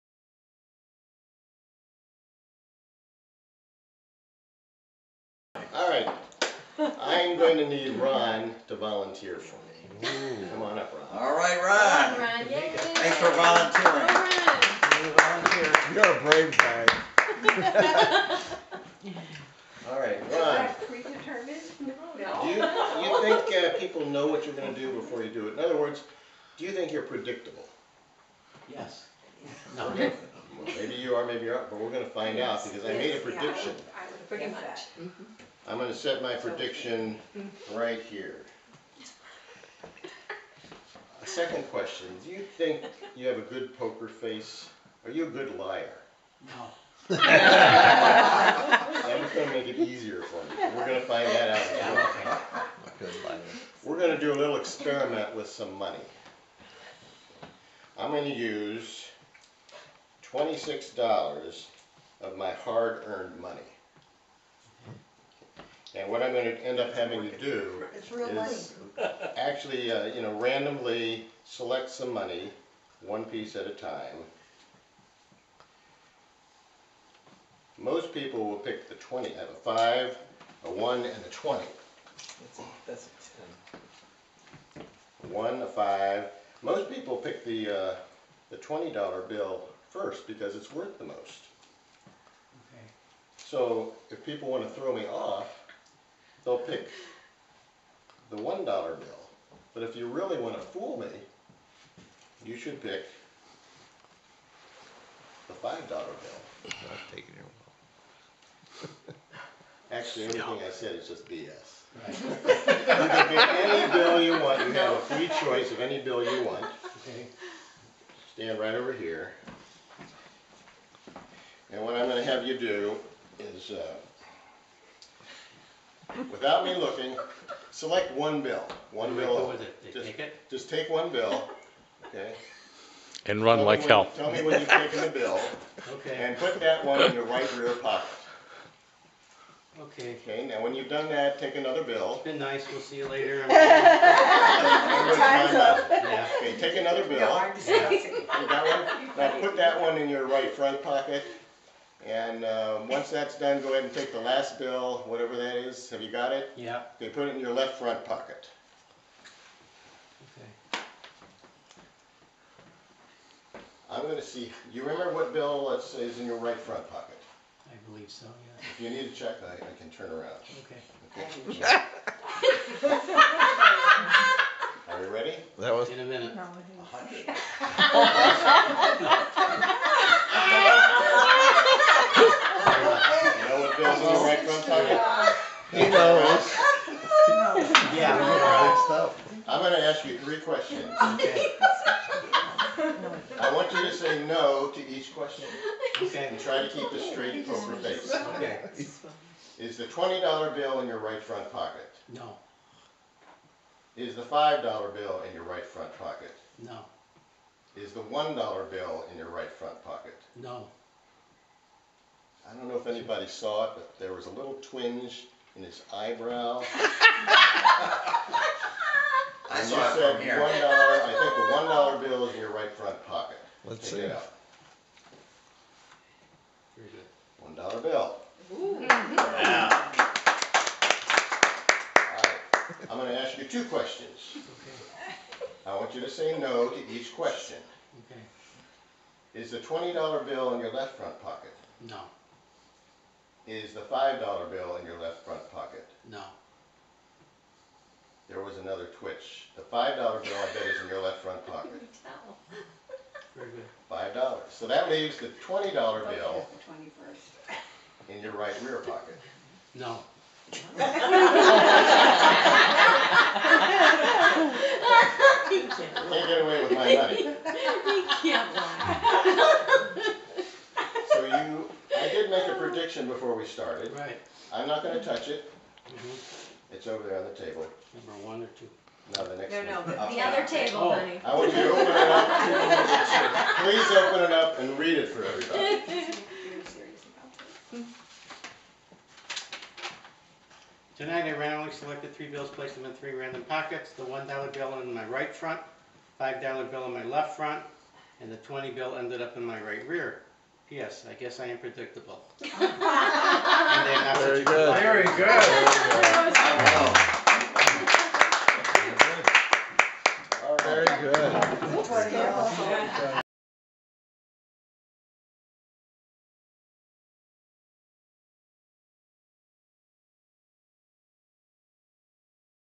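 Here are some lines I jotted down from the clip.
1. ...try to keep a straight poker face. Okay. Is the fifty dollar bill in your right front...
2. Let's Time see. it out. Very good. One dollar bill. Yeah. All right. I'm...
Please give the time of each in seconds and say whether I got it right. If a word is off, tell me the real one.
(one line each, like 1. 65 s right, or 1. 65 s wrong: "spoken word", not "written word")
1. 196 s wrong: "twenty", not "fifty"
2. 223 s wrong: "Take", not "Time".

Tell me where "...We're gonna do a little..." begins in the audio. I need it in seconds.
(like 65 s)
53 s.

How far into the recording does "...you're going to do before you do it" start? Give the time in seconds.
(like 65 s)
24 s.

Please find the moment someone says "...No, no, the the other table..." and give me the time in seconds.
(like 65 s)
279 s.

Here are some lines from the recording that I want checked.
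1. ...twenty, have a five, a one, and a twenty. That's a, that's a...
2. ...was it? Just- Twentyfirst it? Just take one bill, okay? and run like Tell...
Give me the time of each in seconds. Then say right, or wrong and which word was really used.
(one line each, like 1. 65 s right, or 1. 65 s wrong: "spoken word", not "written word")
1. 78 s right
2. 129 s wrong: "Take", not "Twentyfirst".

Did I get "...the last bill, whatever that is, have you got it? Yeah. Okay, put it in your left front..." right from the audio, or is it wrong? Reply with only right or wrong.
right.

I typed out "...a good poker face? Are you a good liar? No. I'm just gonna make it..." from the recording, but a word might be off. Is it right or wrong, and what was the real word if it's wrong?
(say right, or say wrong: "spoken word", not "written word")
right.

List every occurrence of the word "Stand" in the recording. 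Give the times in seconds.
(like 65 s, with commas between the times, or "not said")
118 s.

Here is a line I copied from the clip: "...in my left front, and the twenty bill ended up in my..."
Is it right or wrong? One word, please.
right.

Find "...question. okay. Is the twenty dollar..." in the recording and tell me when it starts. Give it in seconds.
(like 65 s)
237 s.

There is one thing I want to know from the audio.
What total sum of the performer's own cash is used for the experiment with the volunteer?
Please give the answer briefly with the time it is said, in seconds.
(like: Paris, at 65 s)
$26, at 60 s.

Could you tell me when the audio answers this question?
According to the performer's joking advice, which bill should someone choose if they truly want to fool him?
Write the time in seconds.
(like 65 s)
105 s.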